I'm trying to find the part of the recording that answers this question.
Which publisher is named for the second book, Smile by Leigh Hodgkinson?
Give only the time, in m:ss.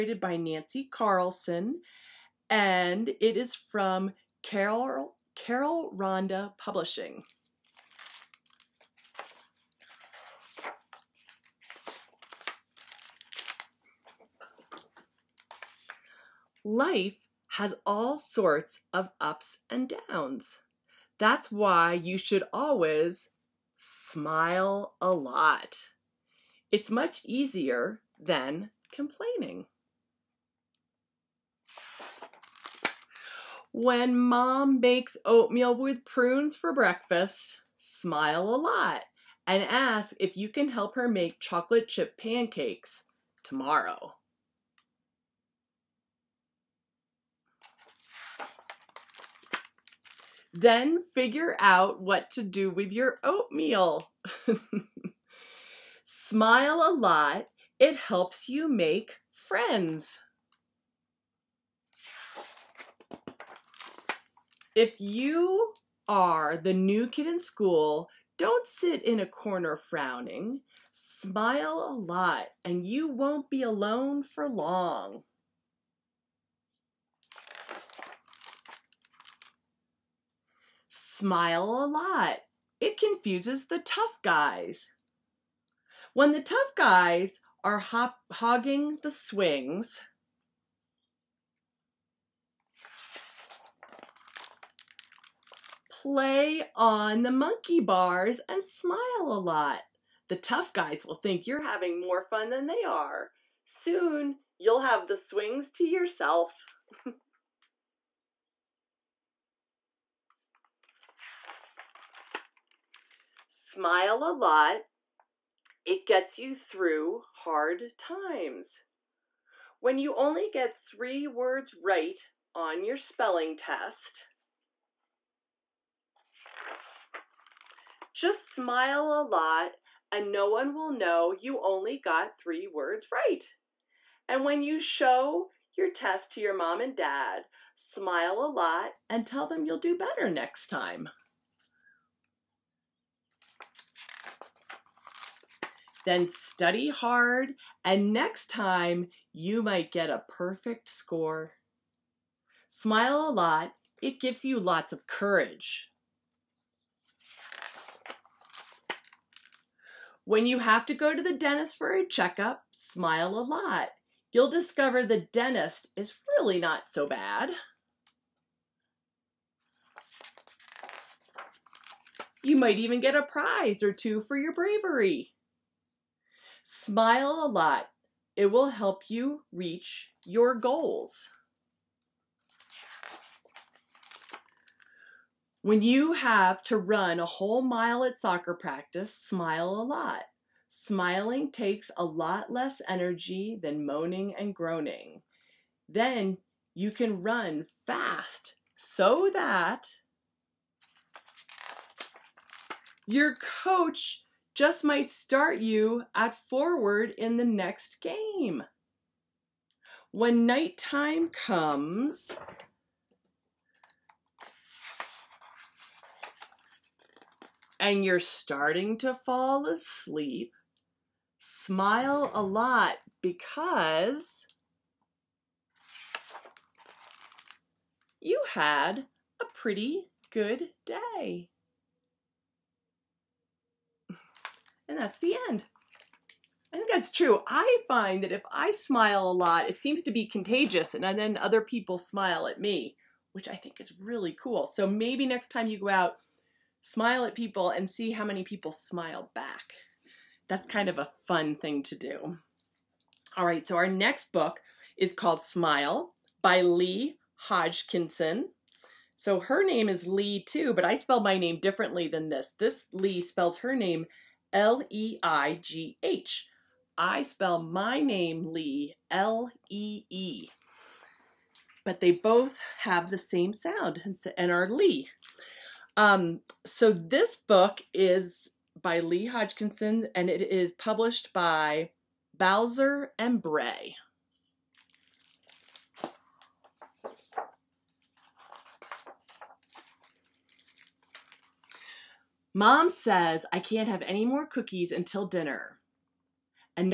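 4:42.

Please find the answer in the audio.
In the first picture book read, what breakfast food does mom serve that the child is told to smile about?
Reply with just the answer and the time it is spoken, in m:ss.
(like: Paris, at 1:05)
oatmeal with prunes, at 0:35.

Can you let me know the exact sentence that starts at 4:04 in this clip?
So maybe next time you go out, smile at people and see how many people smile back.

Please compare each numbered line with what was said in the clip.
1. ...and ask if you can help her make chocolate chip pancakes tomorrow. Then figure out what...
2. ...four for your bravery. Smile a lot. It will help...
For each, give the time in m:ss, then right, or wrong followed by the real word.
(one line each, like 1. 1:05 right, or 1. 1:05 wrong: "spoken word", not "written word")
1. 0:39 right
2. 2:53 wrong: "two", not "four".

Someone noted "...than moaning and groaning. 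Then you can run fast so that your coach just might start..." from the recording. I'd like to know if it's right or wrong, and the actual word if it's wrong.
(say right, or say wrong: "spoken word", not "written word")
right.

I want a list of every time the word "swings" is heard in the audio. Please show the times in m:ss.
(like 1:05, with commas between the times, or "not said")
1:29, 1:45.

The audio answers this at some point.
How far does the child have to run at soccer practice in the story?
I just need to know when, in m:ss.
3:07.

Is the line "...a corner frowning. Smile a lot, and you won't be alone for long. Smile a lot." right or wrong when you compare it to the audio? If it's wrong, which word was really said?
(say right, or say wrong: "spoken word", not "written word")
right.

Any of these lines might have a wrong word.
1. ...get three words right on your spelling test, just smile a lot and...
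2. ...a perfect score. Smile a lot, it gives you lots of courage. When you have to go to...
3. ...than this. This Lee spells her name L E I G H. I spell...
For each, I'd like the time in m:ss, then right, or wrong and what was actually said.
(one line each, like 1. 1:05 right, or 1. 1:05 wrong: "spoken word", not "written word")
1. 2:00 right
2. 2:30 right
3. 4:22 right.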